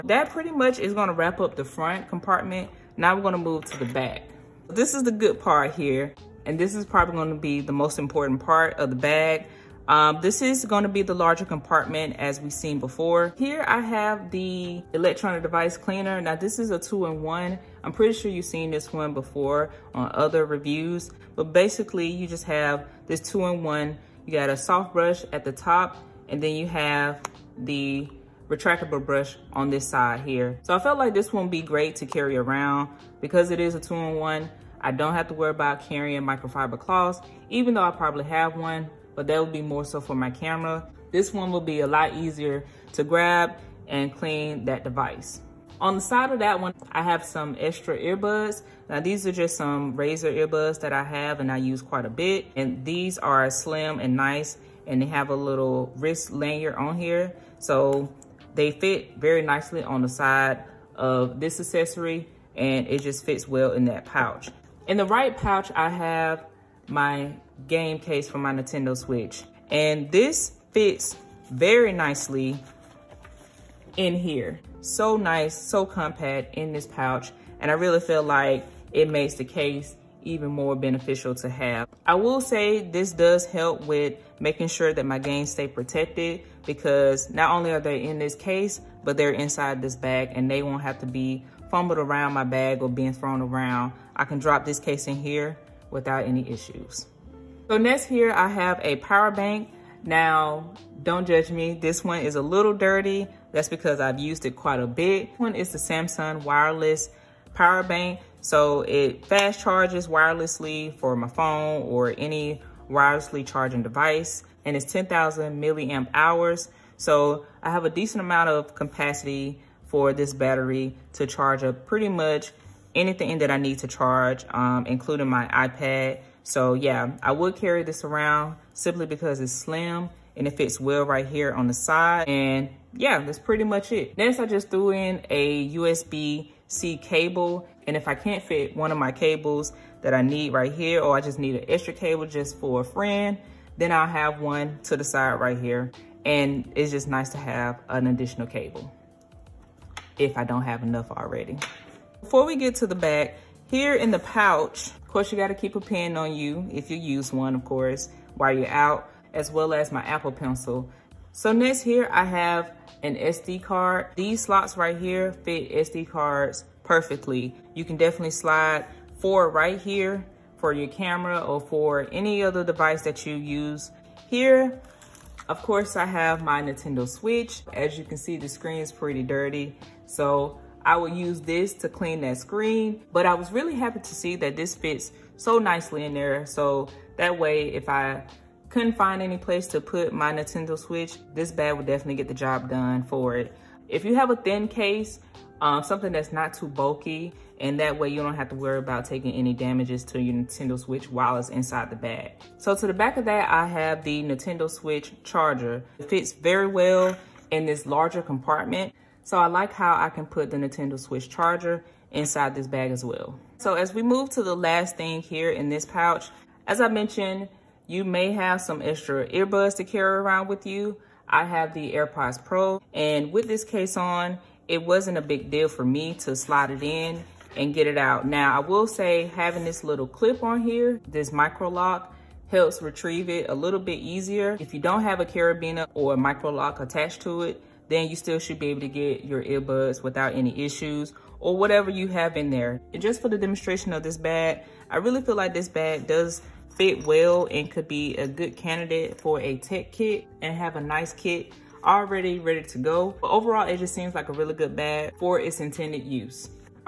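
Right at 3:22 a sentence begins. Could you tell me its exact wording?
So to the back of that, I have the Nintendo Switch charger.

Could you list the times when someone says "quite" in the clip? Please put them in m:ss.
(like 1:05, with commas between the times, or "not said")
0:51, 1:44.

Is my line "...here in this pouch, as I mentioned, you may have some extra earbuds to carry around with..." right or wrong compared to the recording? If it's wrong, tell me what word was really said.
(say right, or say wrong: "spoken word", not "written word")
right.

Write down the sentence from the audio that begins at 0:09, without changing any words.
Um, this is gonna be the larger compartment as we've seen before.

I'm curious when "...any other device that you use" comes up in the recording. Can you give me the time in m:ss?
2:52.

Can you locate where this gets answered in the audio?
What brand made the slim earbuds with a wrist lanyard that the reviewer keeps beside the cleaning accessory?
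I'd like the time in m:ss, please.
0:49.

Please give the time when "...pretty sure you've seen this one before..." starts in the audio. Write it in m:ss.
0:17.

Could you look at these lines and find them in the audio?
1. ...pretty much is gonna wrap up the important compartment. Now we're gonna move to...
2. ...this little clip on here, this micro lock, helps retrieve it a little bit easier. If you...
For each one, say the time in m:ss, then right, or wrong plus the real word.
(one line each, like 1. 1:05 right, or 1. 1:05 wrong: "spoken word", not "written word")
1. 0:00 wrong: "front", not "important"
2. 3:49 right.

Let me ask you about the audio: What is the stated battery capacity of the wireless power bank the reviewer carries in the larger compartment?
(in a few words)
10,000 milliamp hours.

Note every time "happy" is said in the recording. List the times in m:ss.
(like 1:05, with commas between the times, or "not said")
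3:03.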